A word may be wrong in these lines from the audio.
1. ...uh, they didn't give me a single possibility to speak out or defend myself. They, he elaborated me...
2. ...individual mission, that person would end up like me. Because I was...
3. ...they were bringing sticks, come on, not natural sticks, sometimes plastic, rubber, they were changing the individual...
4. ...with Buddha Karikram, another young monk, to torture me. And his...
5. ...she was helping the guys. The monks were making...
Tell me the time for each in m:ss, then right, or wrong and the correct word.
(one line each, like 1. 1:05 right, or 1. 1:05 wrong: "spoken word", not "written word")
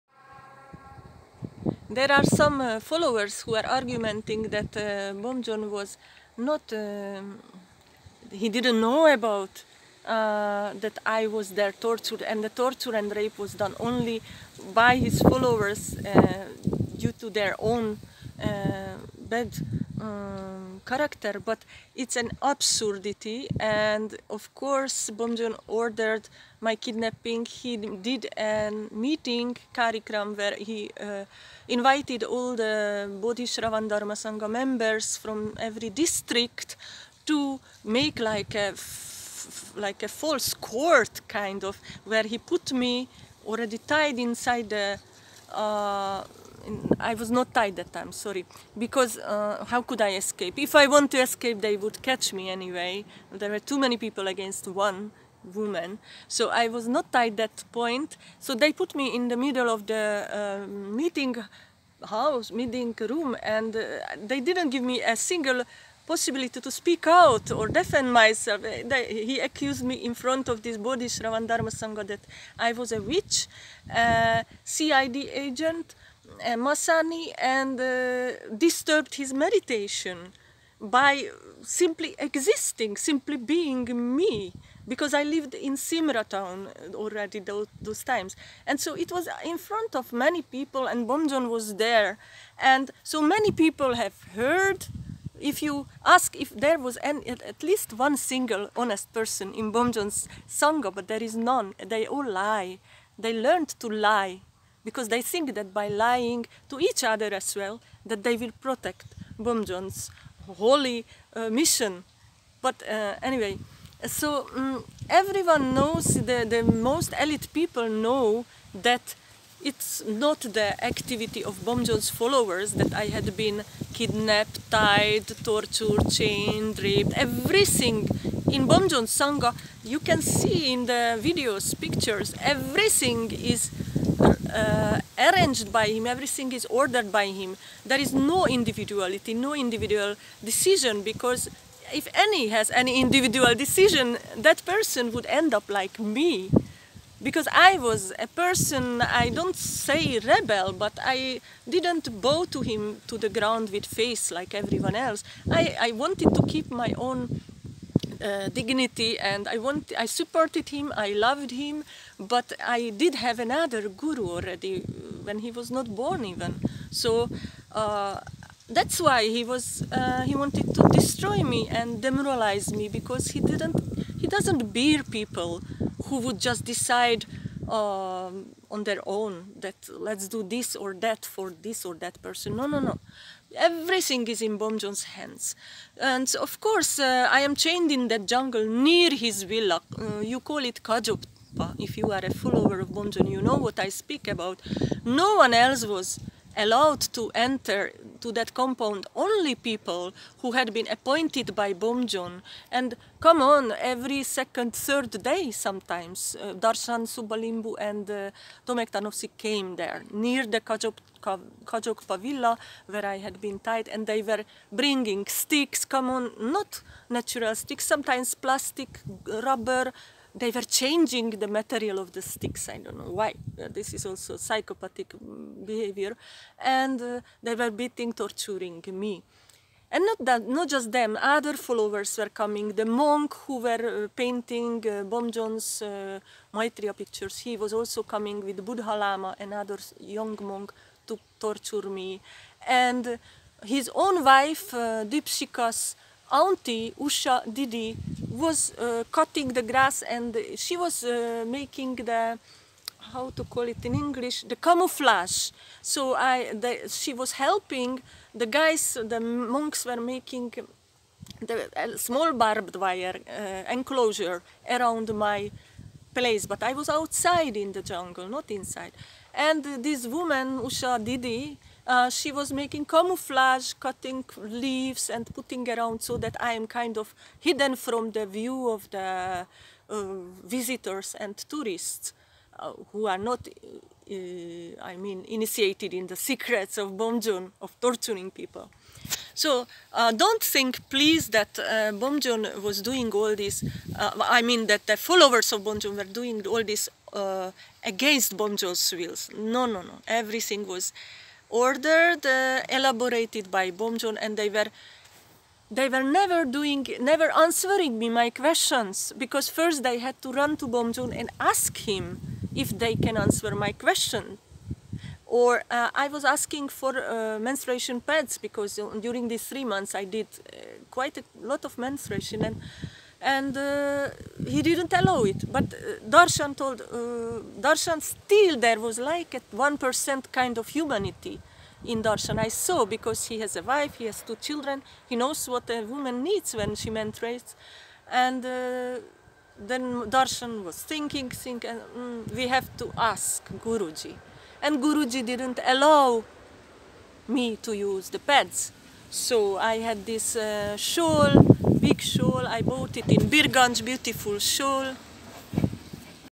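1. 1:03 wrong: "accused", not "elaborated"
2. 2:23 wrong: "decision", not "mission"
3. 3:34 wrong: "material", not "individual"
4. 3:58 wrong: "Lama", not "Karikram"
5. 4:16 right.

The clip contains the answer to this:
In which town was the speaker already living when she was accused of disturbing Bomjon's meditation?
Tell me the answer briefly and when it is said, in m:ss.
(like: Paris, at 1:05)
Simra, at 1:25.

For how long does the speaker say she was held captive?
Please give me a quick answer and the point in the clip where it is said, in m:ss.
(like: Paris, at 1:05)
3 months, at 5:19.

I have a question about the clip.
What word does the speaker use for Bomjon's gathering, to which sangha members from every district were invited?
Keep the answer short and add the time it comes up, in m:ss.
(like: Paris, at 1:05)
Karikram, at 0:29.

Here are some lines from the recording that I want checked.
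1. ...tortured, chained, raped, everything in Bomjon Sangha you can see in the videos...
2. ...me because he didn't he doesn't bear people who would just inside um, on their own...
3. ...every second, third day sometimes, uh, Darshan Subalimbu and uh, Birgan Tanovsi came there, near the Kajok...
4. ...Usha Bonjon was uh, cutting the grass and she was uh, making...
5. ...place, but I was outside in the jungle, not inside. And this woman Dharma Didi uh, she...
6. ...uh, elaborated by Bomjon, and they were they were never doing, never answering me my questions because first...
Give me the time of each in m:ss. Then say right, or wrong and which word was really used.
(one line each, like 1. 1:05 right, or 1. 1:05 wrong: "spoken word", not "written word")
1. 2:05 right
2. 2:52 wrong: "decide", not "inside"
3. 3:23 wrong: "Tomek", not "Birgan"
4. 4:06 wrong: "Didi", not "Bonjon"
5. 4:26 wrong: "Usha", not "Dharma"
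6. 5:02 right.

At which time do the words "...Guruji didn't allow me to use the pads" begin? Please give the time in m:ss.
5:44.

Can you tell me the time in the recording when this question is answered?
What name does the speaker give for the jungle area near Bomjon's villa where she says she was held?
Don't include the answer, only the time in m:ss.
3:10.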